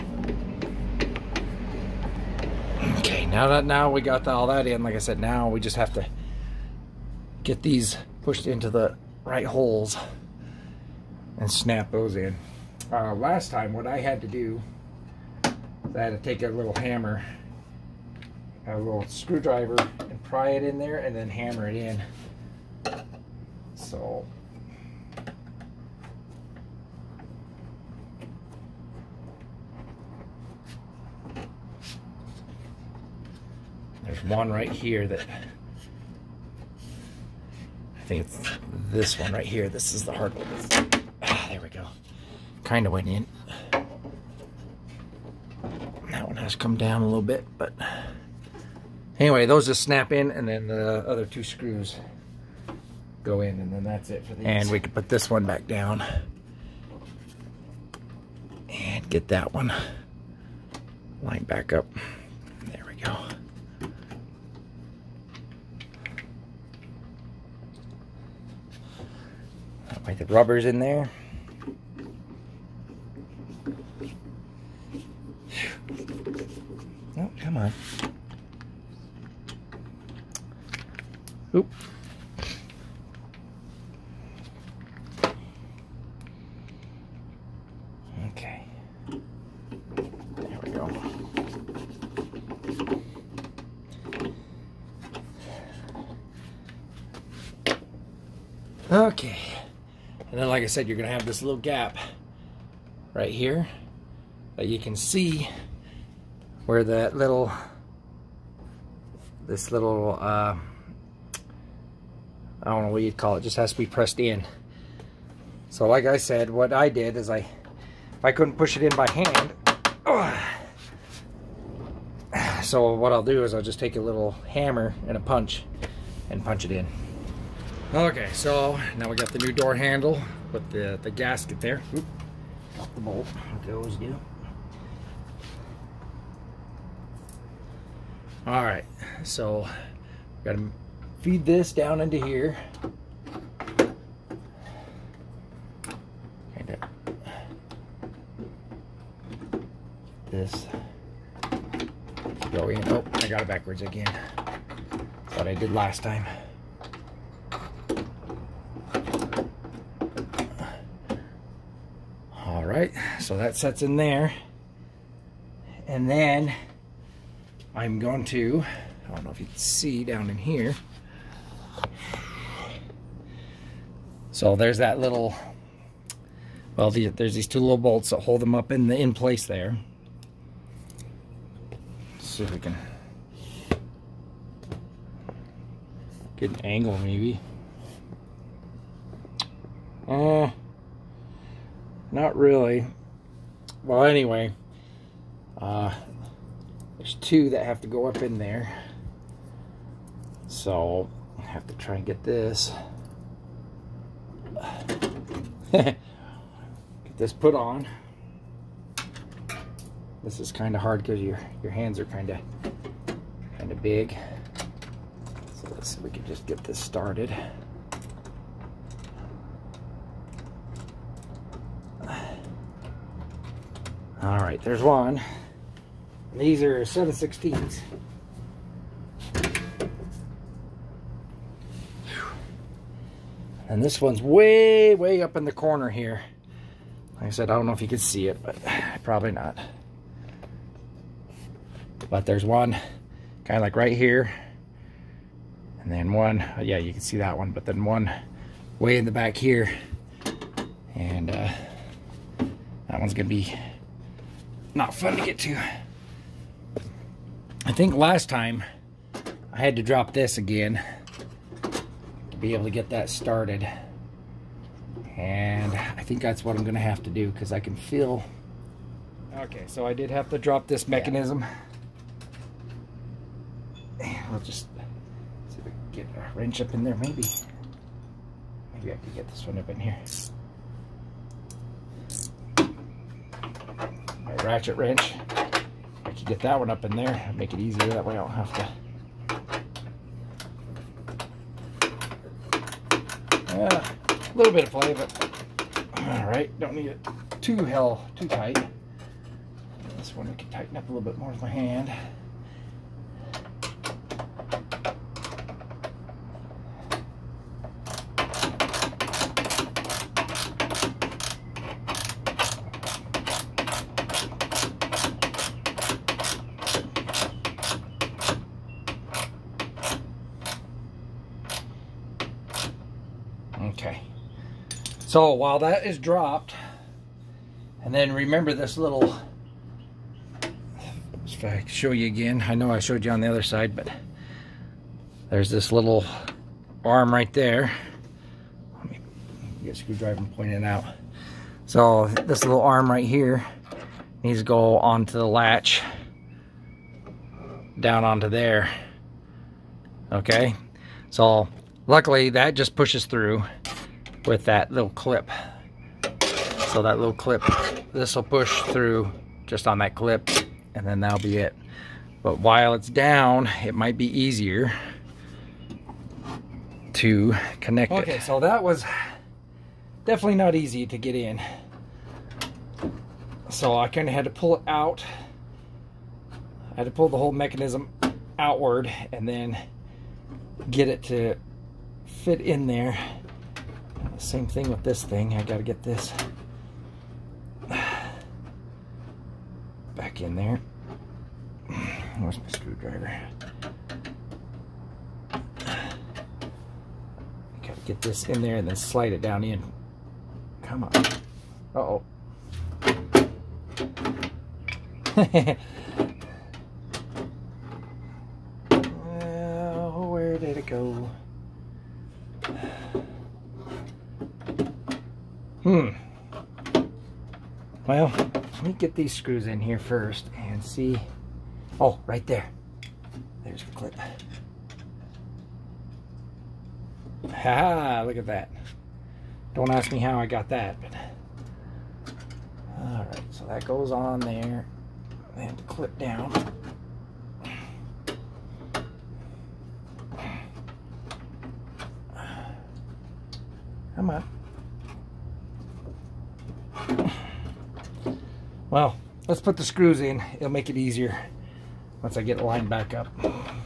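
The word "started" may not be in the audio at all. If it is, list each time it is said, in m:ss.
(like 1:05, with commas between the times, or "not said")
3:36, 4:23.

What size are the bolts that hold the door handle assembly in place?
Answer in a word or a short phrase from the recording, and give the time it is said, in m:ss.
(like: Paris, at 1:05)
7/16, at 3:46.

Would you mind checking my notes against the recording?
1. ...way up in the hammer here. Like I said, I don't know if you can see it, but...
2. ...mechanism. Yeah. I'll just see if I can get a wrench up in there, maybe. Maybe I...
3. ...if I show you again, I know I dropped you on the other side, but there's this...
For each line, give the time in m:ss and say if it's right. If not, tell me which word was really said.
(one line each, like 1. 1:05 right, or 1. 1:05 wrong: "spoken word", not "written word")
1. 3:54 wrong: "corner", not "hammer"
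2. 4:30 right
3. 5:31 wrong: "showed", not "dropped".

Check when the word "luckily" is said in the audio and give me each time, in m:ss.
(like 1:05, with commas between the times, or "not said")
5:51.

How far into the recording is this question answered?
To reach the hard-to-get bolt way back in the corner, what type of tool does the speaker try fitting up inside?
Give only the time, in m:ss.
4:44.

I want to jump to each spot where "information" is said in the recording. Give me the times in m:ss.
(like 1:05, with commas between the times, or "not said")
not said.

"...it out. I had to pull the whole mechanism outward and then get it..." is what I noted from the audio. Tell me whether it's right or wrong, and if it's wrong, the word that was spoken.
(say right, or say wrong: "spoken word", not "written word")
right.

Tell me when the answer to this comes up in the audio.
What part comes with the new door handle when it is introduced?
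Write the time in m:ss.
2:11.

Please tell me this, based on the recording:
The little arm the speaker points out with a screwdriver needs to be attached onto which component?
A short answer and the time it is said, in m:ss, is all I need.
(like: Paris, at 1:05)
the latch, at 5:45.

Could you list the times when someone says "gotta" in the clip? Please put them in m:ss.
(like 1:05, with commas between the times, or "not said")
2:20, 6:25, 6:35.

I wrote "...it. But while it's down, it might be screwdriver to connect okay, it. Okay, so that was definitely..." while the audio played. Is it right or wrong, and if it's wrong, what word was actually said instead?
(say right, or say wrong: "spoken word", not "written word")
wrong: "easier", not "screwdriver".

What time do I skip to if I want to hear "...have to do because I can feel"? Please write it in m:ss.
4:26.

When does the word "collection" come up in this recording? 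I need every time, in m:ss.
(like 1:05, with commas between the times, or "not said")
not said.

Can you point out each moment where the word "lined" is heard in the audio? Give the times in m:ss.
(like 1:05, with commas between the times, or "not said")
1:01, 7:32.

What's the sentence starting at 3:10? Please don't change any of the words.
Uh, not really well, anyway, uh, there's two that have to go up in there.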